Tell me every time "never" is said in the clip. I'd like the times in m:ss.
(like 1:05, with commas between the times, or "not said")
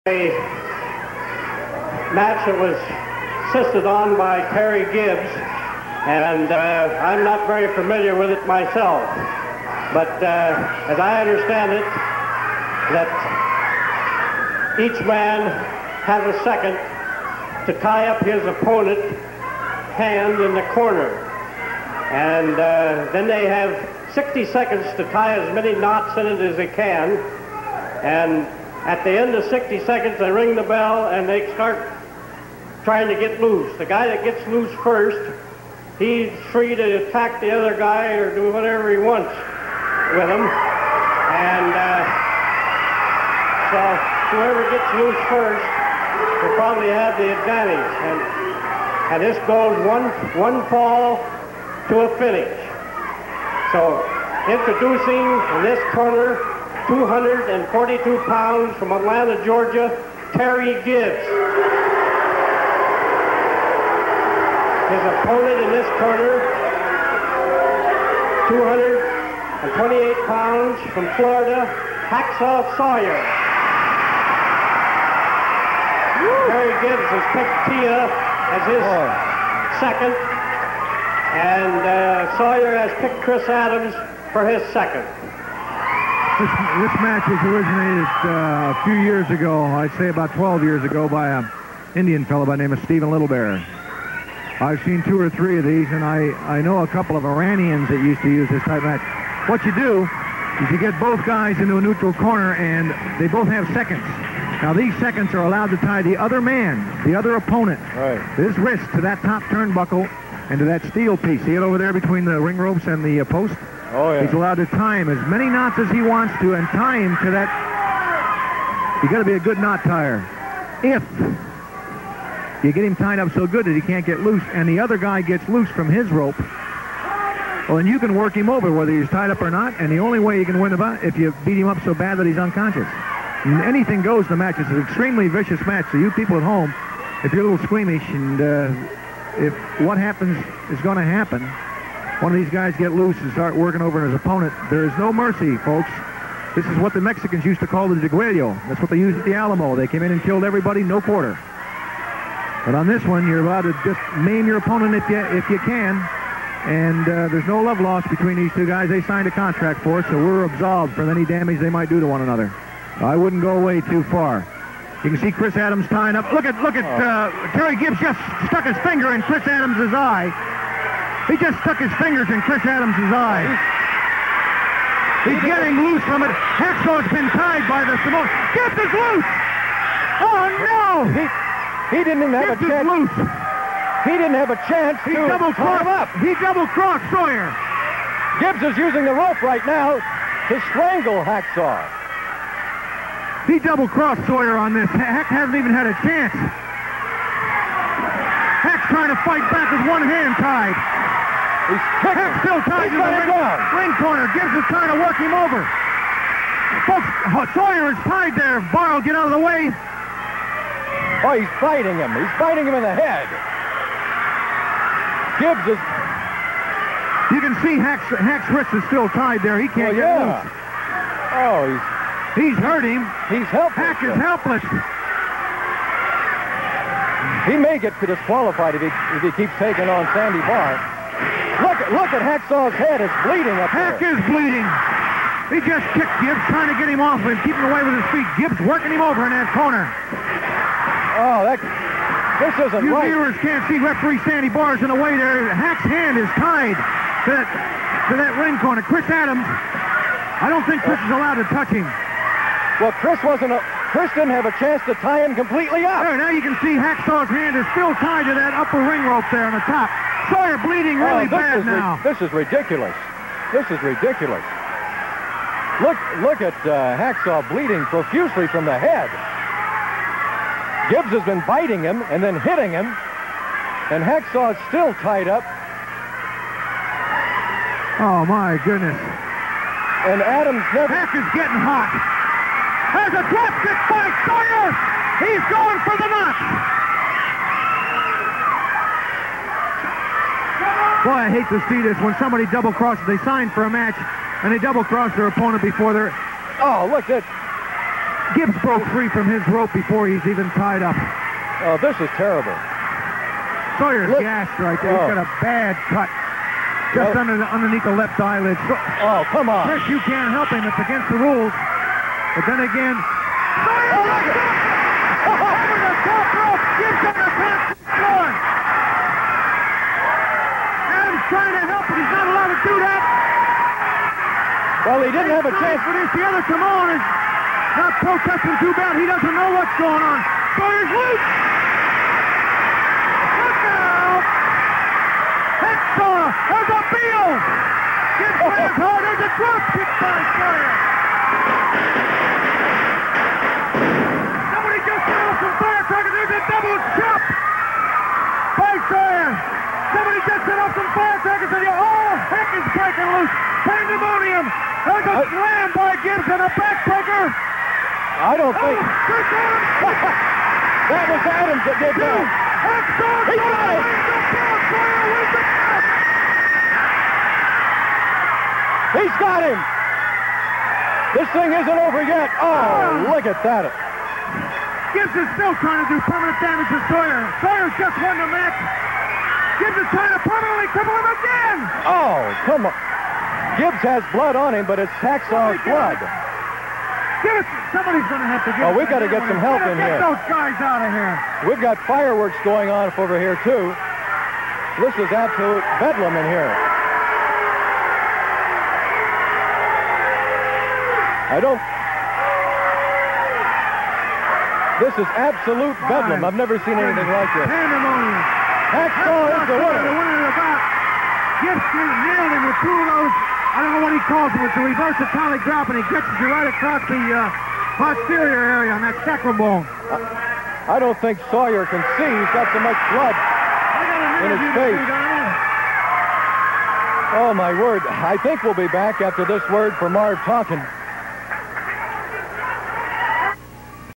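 4:40, 6:46.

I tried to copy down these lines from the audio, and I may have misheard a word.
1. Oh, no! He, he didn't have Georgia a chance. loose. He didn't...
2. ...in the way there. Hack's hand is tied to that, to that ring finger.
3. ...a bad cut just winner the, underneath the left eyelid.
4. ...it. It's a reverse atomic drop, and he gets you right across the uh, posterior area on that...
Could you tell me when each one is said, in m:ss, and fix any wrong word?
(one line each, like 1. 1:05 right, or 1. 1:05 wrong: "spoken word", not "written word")
1. 3:00 wrong: "Gets", not "Georgia"
2. 4:04 wrong: "corner", not "finger"
3. 5:05 wrong: "under", not "winner"
4. 6:54 right.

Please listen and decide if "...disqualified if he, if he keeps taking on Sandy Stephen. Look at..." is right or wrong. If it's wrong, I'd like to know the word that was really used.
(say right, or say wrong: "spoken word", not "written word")
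wrong: "Barr", not "Stephen".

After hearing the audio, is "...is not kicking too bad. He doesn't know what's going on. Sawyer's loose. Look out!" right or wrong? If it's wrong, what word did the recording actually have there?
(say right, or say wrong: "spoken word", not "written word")
wrong: "protesting", not "kicking".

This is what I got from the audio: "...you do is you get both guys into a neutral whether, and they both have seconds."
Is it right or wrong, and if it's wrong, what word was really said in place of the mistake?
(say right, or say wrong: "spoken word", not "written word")
wrong: "corner", not "whether".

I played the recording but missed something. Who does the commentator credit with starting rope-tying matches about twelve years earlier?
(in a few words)
Stephen Littlebear.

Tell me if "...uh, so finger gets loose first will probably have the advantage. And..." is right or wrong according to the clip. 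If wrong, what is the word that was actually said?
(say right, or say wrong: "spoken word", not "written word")
wrong: "whoever", not "finger".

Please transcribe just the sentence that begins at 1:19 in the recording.
second, and uh, Sawyer has picked Chris Adams for his second.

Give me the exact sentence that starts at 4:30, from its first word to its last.
Gibbs has been biting him and then hitting him, and Hacksaw is still tied up.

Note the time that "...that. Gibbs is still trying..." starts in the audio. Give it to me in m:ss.
6:13.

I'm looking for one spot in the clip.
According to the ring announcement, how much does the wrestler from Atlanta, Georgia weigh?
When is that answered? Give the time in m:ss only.
0:56.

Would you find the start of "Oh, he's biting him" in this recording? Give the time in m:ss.
3:31.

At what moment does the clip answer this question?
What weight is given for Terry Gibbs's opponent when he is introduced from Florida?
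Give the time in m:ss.
1:08.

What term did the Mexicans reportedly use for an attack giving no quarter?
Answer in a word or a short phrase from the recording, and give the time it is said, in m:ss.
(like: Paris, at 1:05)
degüello, at 2:27.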